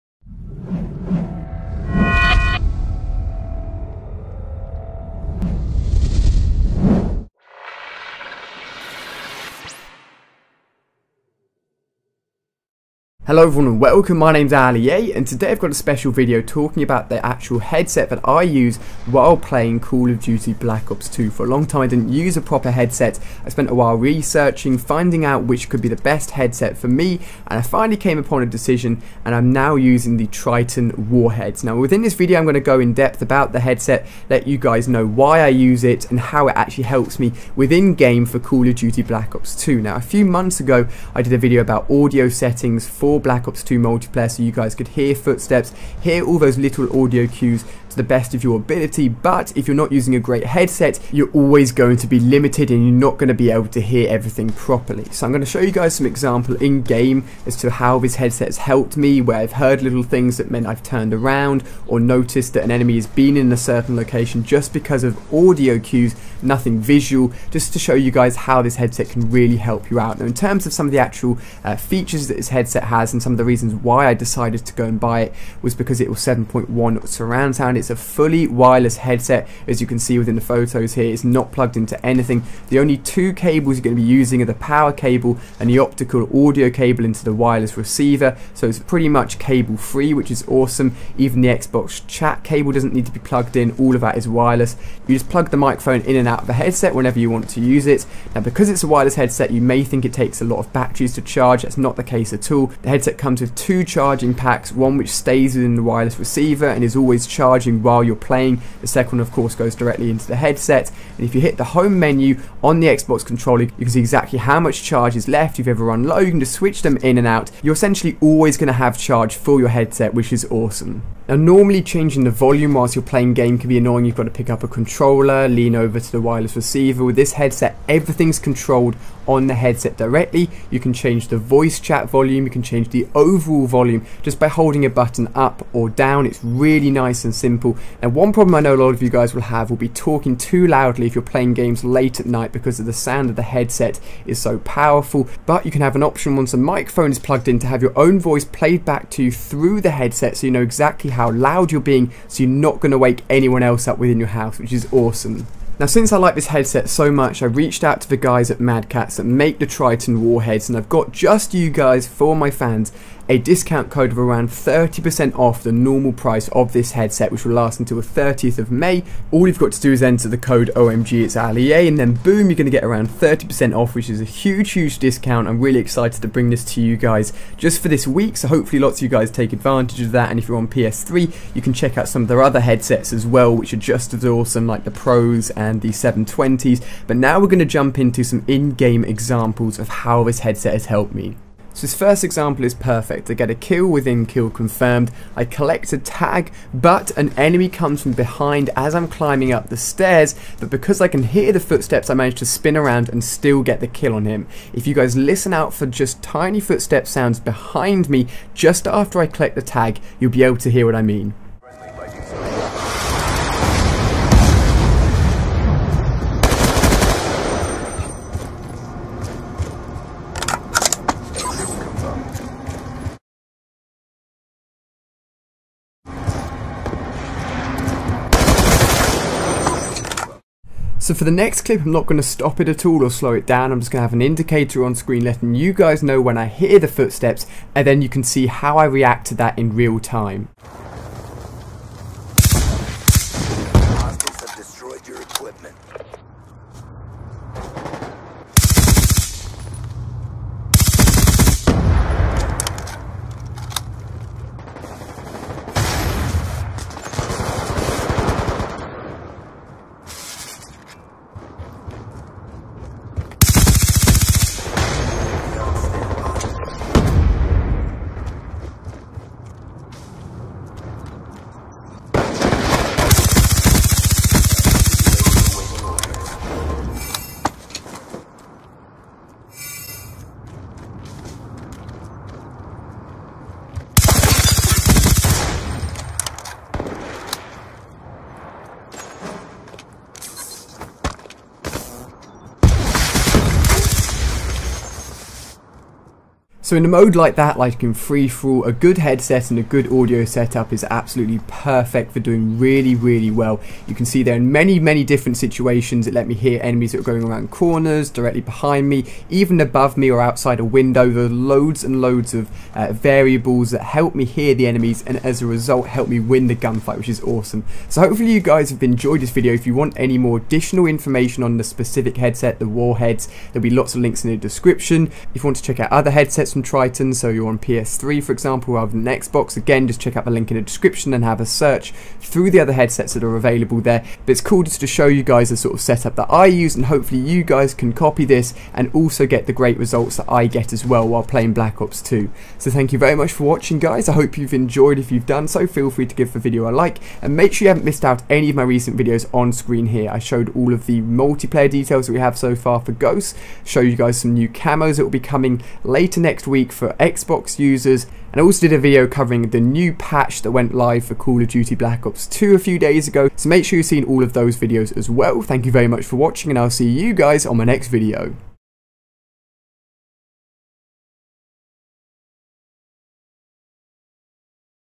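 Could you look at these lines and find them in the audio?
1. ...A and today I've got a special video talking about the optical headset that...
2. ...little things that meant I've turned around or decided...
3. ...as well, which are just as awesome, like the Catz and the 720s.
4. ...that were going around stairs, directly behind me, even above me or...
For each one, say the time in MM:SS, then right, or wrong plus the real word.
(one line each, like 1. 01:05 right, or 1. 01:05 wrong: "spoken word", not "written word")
1. 00:14 wrong: "actual", not "optical"
2. 00:59 wrong: "noticed", not "decided"
3. 03:03 wrong: "Pros", not "Catz"
4. 05:06 wrong: "corners", not "stairs".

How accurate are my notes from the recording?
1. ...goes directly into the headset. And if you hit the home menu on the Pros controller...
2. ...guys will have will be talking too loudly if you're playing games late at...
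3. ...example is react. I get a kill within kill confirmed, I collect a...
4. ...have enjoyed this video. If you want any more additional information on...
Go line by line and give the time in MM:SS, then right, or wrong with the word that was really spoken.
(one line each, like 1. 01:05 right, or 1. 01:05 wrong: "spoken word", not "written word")
1. 01:49 wrong: "Xbox", not "Pros"
2. 02:19 right
3. 03:12 wrong: "perfect", not "react"
4. 05:18 right.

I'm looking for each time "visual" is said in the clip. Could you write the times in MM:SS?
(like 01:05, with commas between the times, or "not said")
01:06.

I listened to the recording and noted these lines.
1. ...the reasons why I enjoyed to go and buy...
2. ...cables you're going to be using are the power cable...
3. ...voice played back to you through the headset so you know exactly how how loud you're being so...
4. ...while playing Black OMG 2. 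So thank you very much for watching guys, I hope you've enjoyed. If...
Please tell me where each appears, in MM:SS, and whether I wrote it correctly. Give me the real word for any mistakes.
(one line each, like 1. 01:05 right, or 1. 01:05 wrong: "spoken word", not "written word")
1. 01:13 wrong: "decided", not "enjoyed"
2. 01:23 right
3. 02:28 right
4. 05:41 wrong: "Ops", not "OMG".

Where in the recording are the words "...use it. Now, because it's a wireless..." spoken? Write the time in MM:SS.
01:37.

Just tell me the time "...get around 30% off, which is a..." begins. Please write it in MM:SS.
02:52.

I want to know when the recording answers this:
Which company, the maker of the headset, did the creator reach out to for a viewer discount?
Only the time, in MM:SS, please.
02:38.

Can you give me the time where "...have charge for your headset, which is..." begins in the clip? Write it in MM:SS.
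01:58.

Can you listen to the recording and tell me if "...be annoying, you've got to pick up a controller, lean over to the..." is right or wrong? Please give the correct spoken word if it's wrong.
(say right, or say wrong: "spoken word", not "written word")
right.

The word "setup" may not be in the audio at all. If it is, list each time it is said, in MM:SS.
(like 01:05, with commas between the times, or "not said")
05:00, 05:35.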